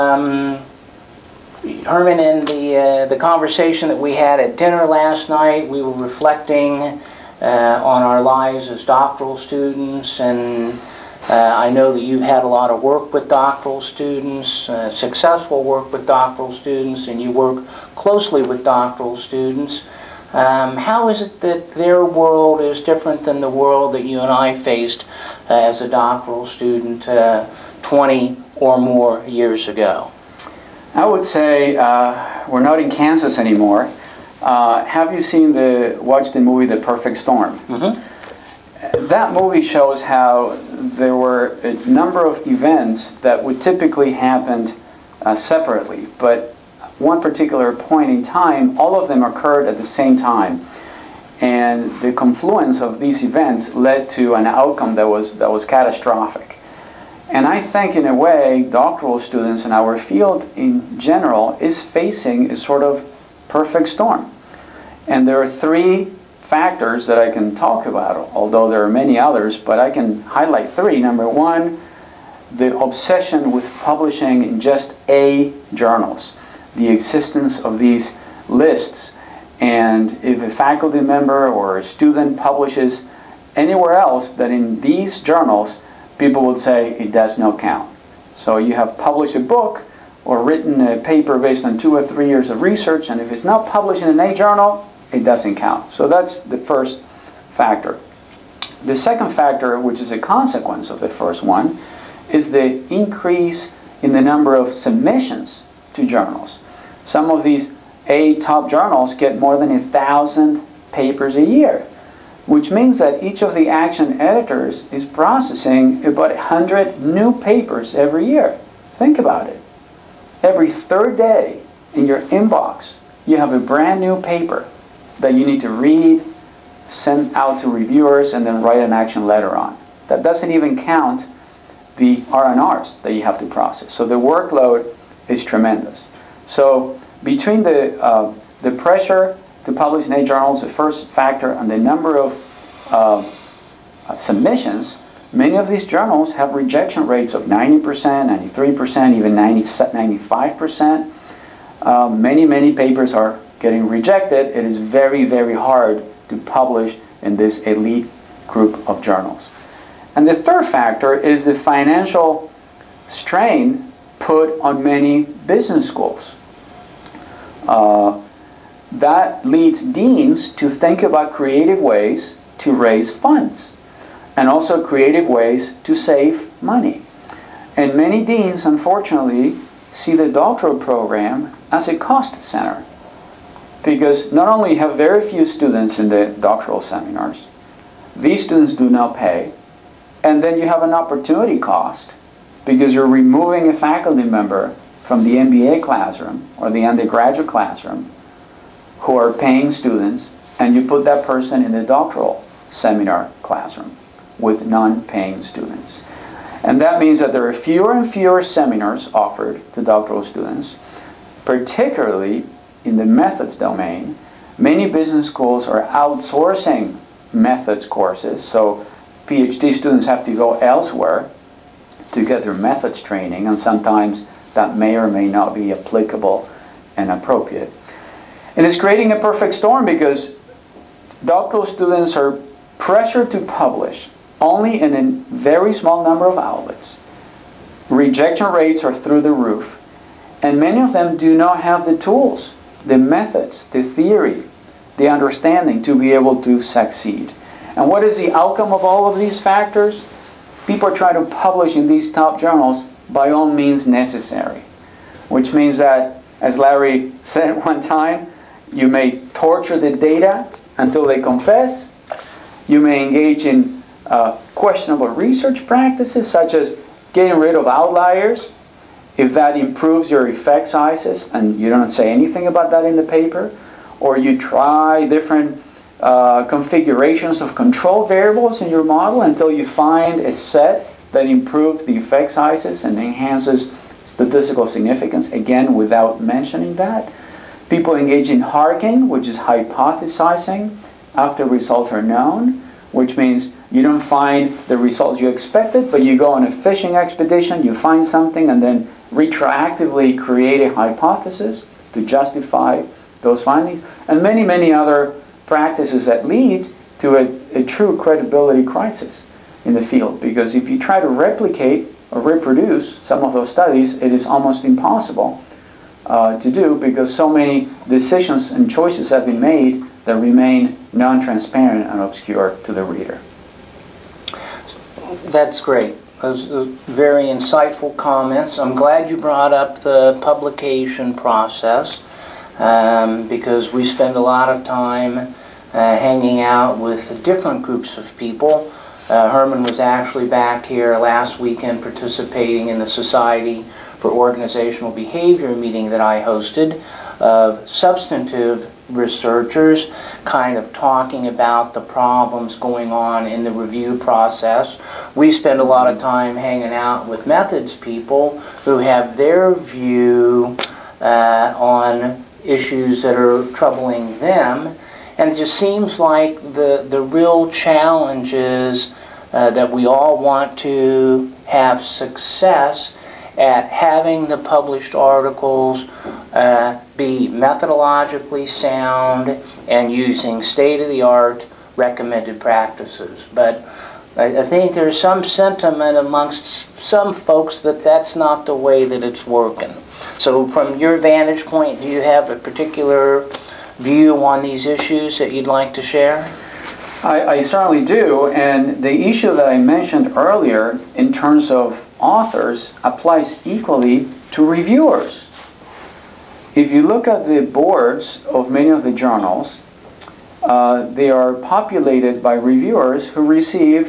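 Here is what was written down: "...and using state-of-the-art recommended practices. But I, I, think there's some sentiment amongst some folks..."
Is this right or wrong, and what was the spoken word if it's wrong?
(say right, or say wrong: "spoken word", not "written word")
right.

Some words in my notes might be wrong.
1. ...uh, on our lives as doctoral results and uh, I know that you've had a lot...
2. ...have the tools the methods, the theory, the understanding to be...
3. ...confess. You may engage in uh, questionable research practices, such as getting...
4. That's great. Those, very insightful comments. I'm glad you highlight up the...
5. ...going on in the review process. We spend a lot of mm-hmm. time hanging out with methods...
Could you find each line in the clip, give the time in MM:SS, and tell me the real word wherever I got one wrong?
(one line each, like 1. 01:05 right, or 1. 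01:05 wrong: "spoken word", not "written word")
1. 00:07 wrong: "students", not "results"
2. 04:01 right
3. 04:21 right
4. 05:25 wrong: "brought", not "highlight"
5. 05:52 right.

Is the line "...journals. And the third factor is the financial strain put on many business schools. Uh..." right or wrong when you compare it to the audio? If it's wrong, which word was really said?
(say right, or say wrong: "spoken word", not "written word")
right.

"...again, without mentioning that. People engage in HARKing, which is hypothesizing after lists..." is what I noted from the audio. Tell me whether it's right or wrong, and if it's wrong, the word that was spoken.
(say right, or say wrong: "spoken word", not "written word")
wrong: "results", not "lists".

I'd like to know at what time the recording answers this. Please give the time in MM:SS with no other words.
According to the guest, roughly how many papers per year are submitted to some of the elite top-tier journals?
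01:49.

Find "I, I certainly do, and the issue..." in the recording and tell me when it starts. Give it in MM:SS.
06:37.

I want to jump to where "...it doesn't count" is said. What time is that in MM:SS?
01:35.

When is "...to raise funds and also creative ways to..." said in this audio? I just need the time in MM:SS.
02:52.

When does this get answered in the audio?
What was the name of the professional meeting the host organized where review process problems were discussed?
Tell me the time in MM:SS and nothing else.
05:42.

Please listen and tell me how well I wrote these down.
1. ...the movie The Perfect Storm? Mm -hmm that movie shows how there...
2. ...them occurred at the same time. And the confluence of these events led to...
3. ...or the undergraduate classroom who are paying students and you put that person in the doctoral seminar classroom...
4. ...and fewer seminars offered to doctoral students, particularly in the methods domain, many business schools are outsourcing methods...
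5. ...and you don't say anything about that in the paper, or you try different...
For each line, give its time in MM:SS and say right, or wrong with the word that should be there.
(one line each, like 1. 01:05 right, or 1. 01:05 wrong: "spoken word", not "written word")
1. 00:36 right
2. 00:49 right
3. 03:16 right
4. 03:27 right
5. 04:31 right.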